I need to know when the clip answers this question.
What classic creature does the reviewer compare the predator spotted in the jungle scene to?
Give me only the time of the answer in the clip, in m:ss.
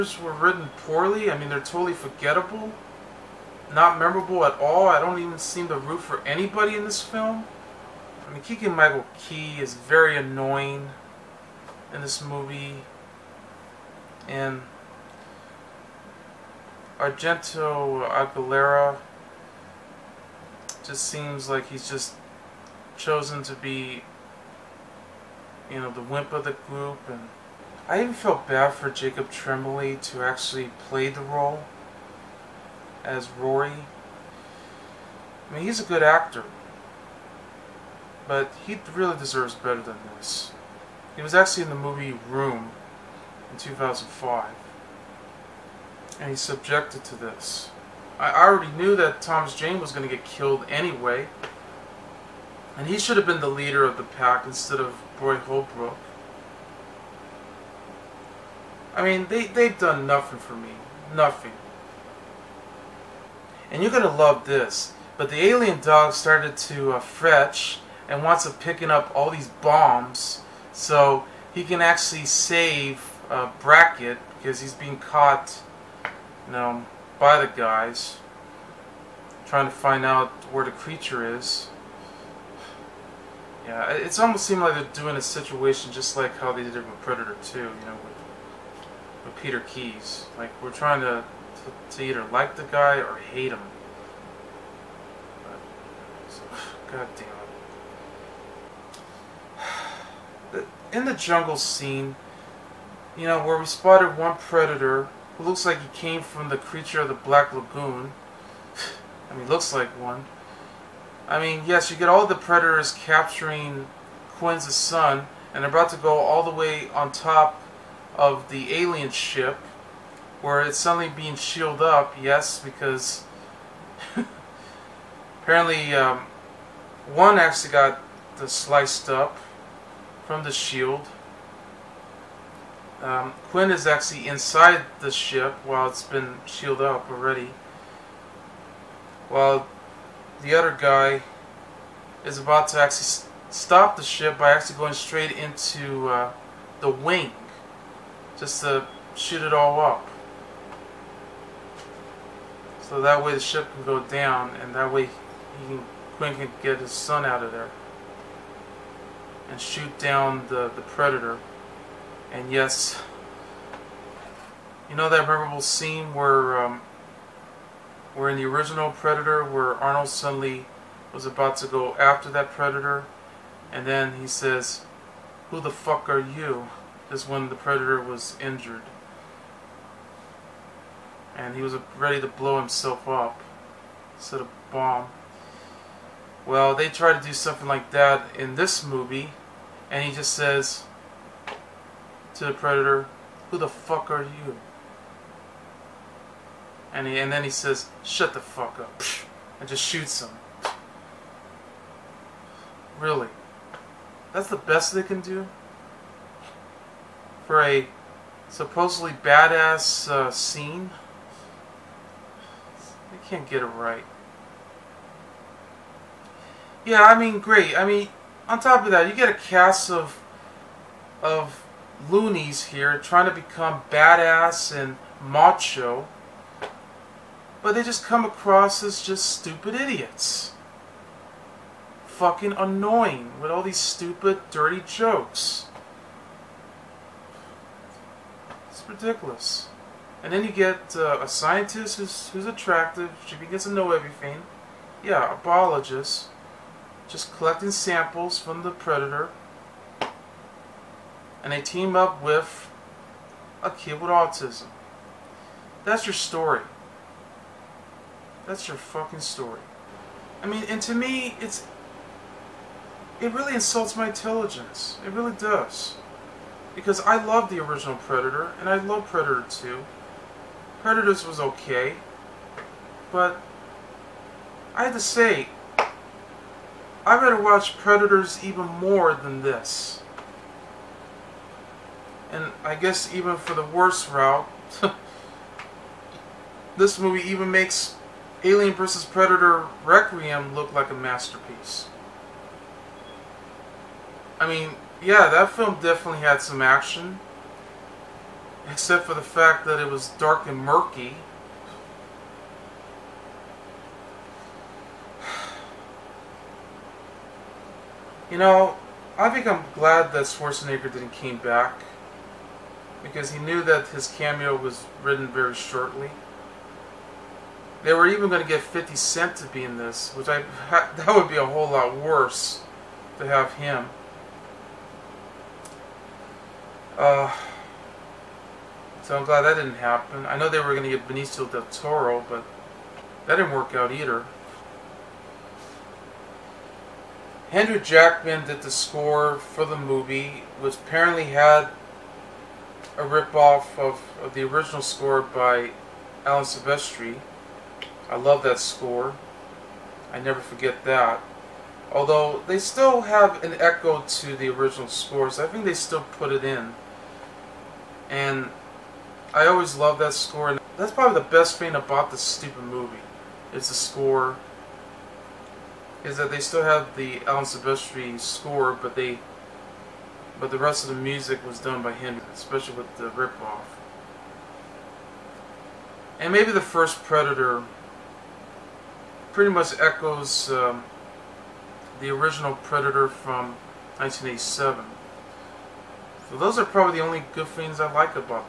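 1:46.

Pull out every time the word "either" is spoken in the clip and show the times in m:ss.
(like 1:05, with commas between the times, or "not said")
1:32, 5:33.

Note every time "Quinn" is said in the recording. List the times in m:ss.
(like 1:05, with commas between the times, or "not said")
1:54, 2:13, 2:36.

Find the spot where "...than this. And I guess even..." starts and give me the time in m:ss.
4:39.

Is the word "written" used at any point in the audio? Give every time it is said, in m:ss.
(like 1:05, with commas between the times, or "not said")
0:00, 5:15.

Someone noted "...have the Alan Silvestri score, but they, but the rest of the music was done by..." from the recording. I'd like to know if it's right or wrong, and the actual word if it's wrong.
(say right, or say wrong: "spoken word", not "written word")
right.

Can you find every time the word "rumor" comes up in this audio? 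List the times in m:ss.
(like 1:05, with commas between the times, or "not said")
not said.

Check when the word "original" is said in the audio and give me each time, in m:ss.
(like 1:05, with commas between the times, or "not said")
2:48, 4:27, 5:44, 5:54, 6:22.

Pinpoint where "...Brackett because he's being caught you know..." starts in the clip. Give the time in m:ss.
1:13.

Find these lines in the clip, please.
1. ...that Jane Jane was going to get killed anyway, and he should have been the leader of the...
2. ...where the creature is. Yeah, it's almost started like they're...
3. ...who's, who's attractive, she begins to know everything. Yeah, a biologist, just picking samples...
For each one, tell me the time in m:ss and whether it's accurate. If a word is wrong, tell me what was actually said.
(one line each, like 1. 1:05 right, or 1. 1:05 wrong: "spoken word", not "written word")
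1. 0:48 wrong: "Thomas", not "Jane"
2. 1:20 wrong: "seemed", not "started"
3. 4:01 wrong: "collecting", not "picking".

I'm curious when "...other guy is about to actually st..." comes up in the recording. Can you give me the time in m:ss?
2:20.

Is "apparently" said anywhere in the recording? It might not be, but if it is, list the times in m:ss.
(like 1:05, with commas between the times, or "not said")
2:05, 5:40.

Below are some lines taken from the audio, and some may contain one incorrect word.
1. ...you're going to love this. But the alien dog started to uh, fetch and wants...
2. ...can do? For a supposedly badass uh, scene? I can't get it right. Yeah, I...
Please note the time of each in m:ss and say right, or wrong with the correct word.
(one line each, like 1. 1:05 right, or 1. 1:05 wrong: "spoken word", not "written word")
1. 1:03 right
2. 3:25 right.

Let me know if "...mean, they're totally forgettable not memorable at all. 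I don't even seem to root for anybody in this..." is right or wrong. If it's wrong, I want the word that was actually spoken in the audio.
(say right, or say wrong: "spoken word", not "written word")
right.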